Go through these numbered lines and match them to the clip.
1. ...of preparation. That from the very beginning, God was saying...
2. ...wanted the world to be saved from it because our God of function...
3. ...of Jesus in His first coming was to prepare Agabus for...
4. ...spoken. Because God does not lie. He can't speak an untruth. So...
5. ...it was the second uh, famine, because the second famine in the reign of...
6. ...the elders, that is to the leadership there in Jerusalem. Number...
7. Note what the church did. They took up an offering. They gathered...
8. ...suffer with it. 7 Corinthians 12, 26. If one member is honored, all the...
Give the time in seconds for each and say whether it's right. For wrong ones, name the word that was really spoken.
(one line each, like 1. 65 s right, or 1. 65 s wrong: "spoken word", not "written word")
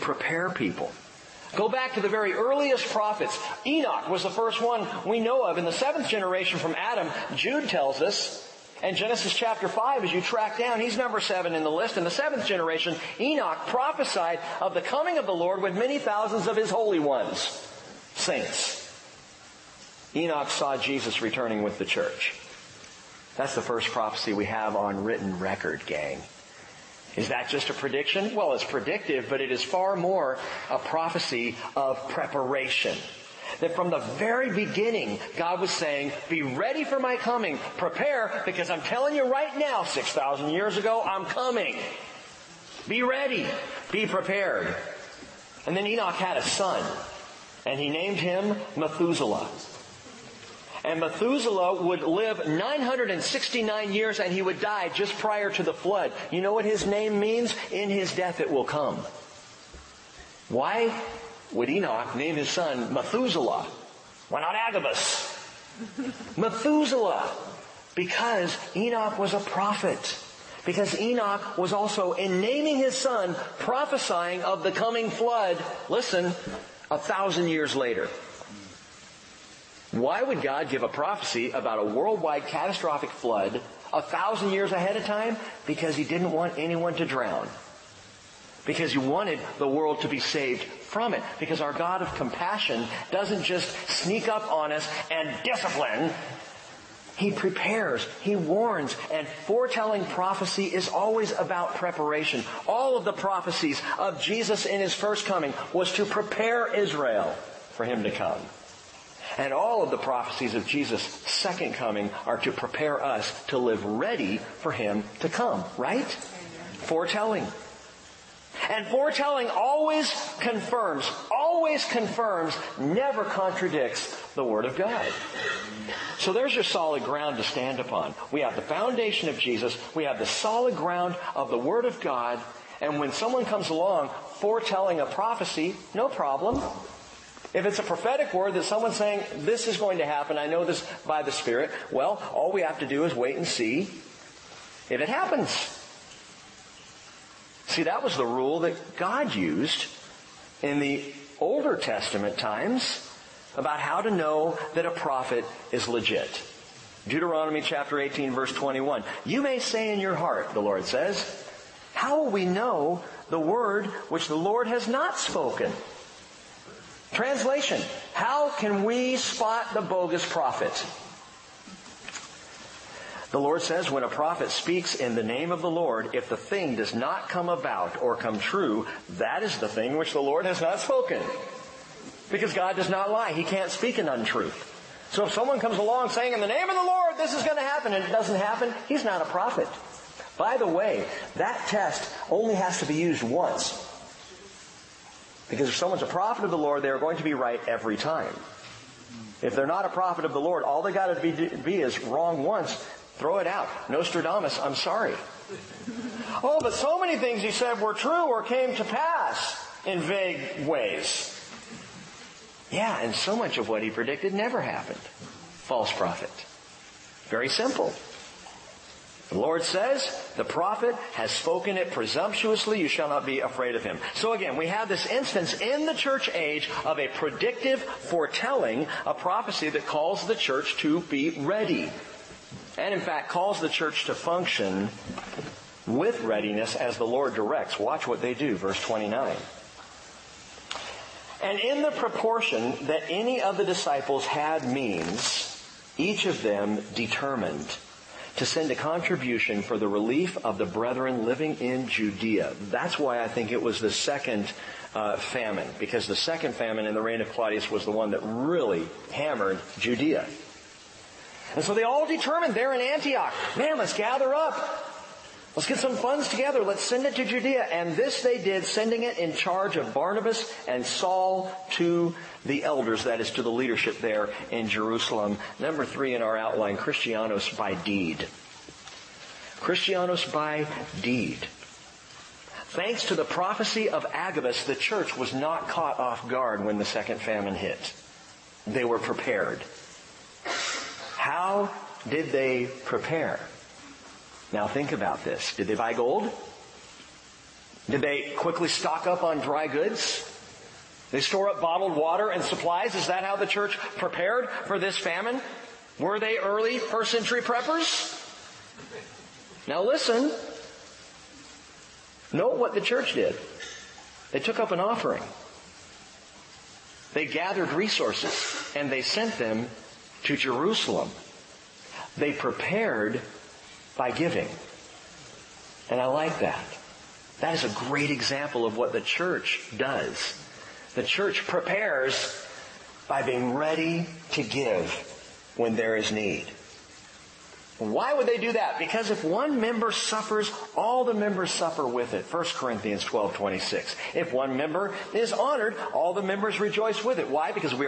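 1. 31 s right
2. 88 s wrong: "compassion", not "function"
3. 103 s wrong: "Israel", not "Agabus"
4. 180 s right
5. 253 s right
6. 272 s right
7. 312 s right
8. 341 s wrong: "1", not "7".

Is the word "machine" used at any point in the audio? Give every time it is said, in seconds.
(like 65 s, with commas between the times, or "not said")
not said.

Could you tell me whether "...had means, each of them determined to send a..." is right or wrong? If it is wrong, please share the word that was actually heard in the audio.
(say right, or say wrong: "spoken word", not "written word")
right.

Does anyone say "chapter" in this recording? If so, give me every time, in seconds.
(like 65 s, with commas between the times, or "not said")
9 s, 157 s.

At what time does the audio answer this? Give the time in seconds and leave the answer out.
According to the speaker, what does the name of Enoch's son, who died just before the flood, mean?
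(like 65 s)
57 s.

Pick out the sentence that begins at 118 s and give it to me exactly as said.
And foretelling always confirms, always confirms, never contradicts the Word of God.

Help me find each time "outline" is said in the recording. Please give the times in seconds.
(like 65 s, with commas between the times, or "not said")
276 s.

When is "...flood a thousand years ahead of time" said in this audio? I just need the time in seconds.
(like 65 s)
83 s.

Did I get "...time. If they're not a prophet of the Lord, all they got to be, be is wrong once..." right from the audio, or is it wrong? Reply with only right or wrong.
right.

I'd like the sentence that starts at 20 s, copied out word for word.
Enoch saw Jesus returning with the church.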